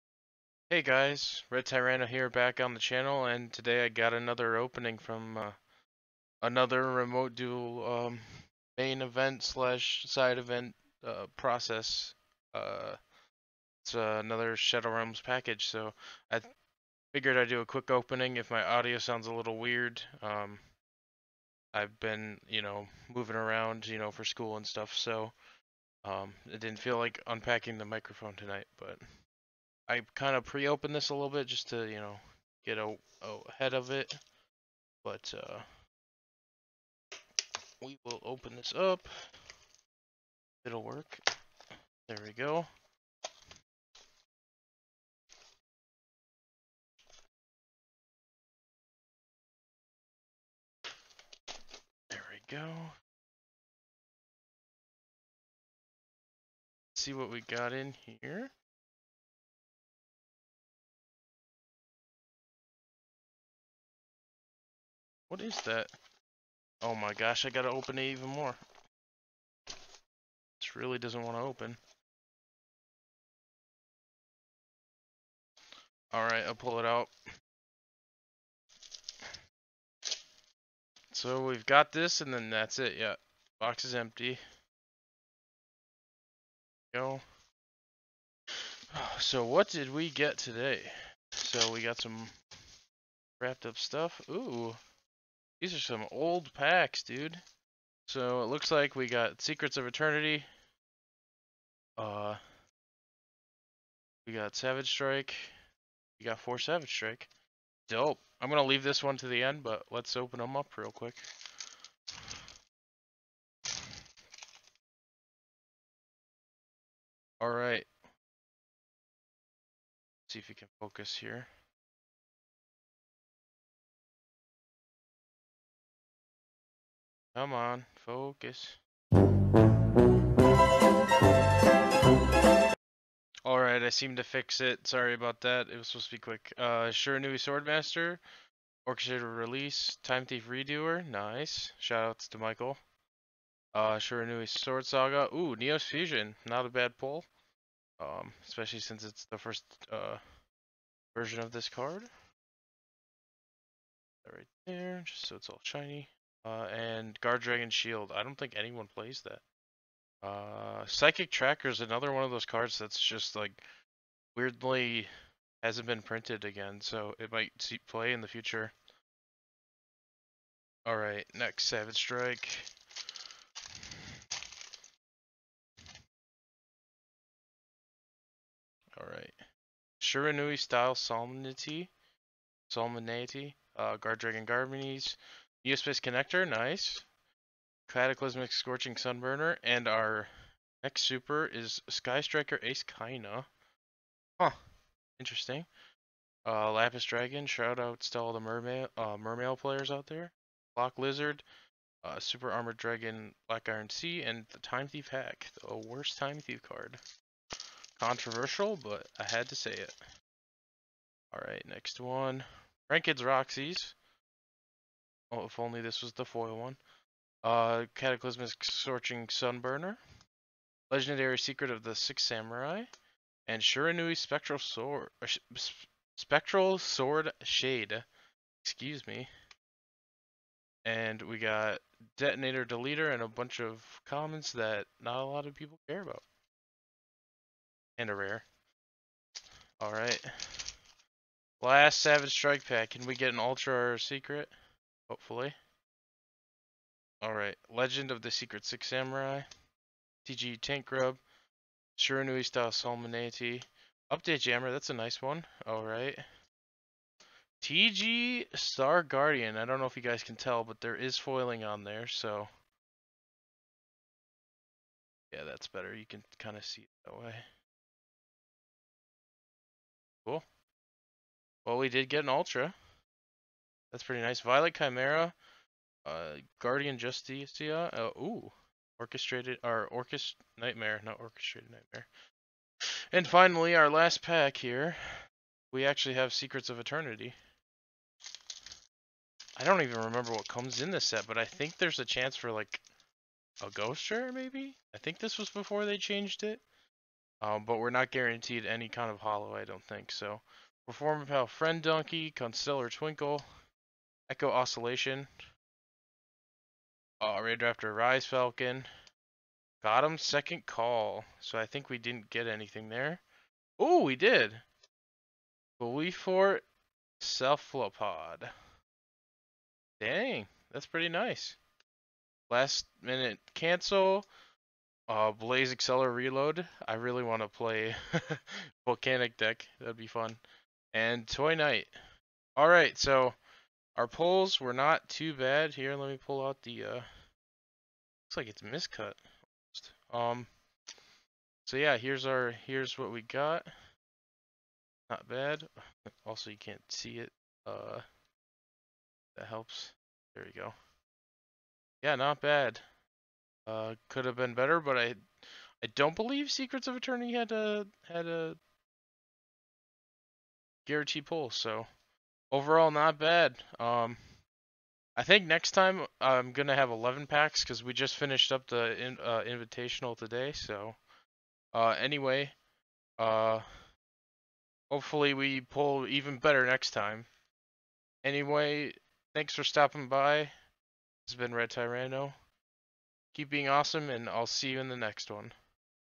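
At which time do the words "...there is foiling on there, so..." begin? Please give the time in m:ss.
4:20.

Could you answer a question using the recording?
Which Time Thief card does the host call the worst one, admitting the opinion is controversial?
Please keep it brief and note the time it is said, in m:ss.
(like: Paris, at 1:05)
Time Thief Hack, at 3:24.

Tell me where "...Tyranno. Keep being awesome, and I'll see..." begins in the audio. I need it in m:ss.
6:21.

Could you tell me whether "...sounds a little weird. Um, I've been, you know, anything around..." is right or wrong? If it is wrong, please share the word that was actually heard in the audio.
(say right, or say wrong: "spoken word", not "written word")
wrong: "moving", not "anything".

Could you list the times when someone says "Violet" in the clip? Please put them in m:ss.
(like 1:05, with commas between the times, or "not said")
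4:34.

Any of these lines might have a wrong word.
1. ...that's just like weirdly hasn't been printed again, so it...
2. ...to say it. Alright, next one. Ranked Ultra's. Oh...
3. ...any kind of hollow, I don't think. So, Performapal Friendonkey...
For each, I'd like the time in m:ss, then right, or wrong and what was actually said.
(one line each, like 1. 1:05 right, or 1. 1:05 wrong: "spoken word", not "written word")
1. 2:42 right
2. 3:29 wrong: "Roxy", not "Ultra"
3. 4:58 right.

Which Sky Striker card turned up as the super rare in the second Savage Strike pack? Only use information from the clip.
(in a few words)
Sky Striker Ace Kaina.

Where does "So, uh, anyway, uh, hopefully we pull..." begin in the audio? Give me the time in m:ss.
6:10.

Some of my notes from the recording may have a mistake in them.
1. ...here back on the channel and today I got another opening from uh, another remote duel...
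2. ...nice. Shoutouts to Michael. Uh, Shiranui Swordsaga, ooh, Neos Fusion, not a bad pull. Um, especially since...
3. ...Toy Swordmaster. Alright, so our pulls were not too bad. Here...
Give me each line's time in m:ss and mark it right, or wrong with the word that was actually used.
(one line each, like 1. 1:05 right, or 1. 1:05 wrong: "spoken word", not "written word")
1. 0:02 right
2. 2:21 right
3. 5:31 wrong: "Knight", not "Swordmaster".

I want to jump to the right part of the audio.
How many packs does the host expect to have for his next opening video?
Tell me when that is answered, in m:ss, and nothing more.
6:06.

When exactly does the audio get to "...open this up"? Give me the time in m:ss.
0:38.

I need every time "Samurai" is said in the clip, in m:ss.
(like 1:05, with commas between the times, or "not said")
3:42, 4:08.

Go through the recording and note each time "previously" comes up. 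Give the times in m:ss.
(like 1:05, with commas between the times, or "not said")
not said.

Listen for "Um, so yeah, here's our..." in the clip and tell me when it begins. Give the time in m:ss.
5:40.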